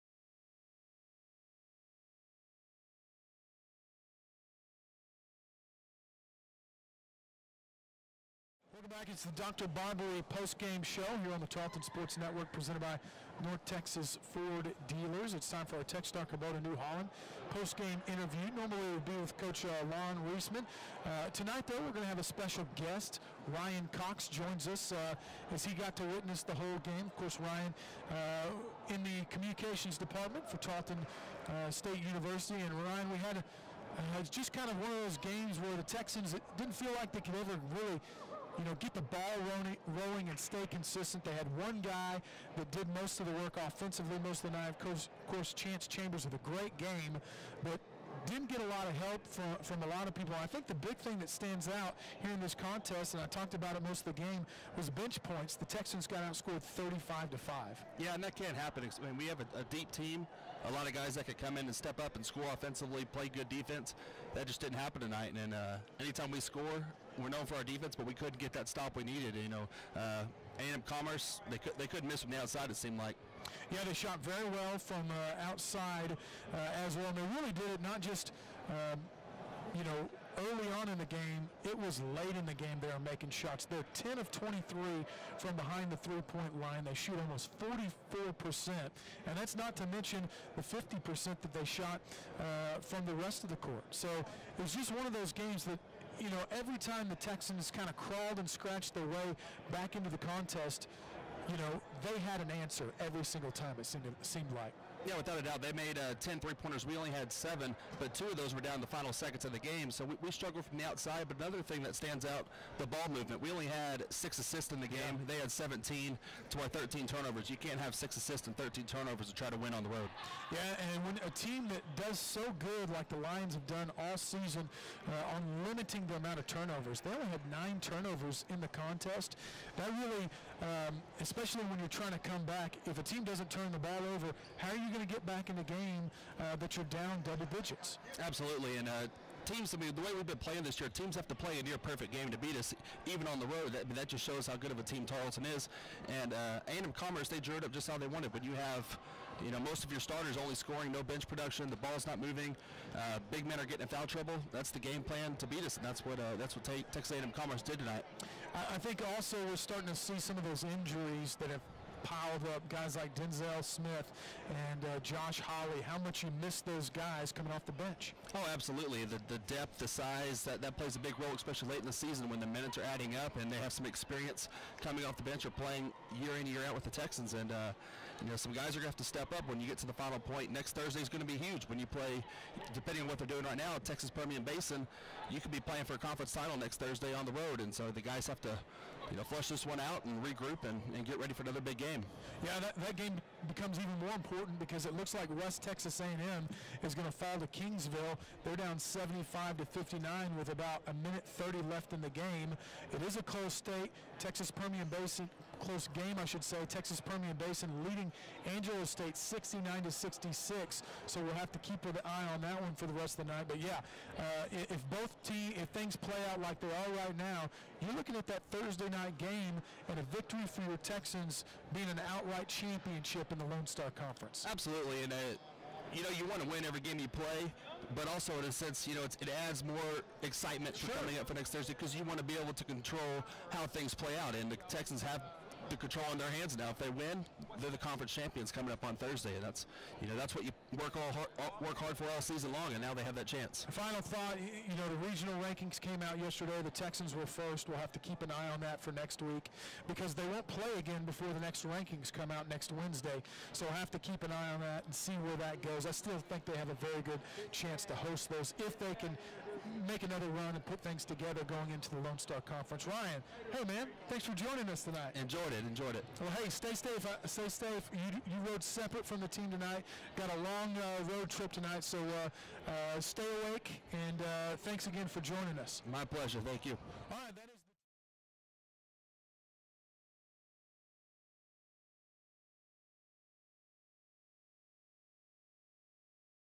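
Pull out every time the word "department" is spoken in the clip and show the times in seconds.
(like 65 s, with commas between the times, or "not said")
29 s.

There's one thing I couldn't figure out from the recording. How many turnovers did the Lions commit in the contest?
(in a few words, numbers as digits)
9.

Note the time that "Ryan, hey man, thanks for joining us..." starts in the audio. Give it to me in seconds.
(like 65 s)
262 s.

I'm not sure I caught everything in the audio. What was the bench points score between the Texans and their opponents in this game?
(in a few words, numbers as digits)
35 to 5.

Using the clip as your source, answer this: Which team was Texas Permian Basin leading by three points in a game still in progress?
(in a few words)
Angelo State.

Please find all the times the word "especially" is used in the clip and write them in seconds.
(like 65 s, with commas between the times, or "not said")
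131 s, 171 s.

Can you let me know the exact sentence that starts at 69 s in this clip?
You know, uh, A&M Commerce, they, could, they couldn't miss from the outside, it seemed like.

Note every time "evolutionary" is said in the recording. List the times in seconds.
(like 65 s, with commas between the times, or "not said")
not said.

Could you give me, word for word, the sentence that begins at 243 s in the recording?
Final thought, you know, the regional rankings came out yesterday.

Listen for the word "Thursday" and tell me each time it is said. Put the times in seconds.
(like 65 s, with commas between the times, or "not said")
180 s, 186 s, 218 s, 231 s, 238 s.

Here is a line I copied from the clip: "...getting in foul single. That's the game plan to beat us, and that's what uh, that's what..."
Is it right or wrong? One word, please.
wrong.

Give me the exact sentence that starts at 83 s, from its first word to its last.
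They're 10 of 23 from behind the three-point line.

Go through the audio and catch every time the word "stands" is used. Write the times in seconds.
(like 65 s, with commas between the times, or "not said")
51 s, 111 s.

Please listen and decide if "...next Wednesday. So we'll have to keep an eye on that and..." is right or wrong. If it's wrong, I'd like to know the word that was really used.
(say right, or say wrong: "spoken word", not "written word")
right.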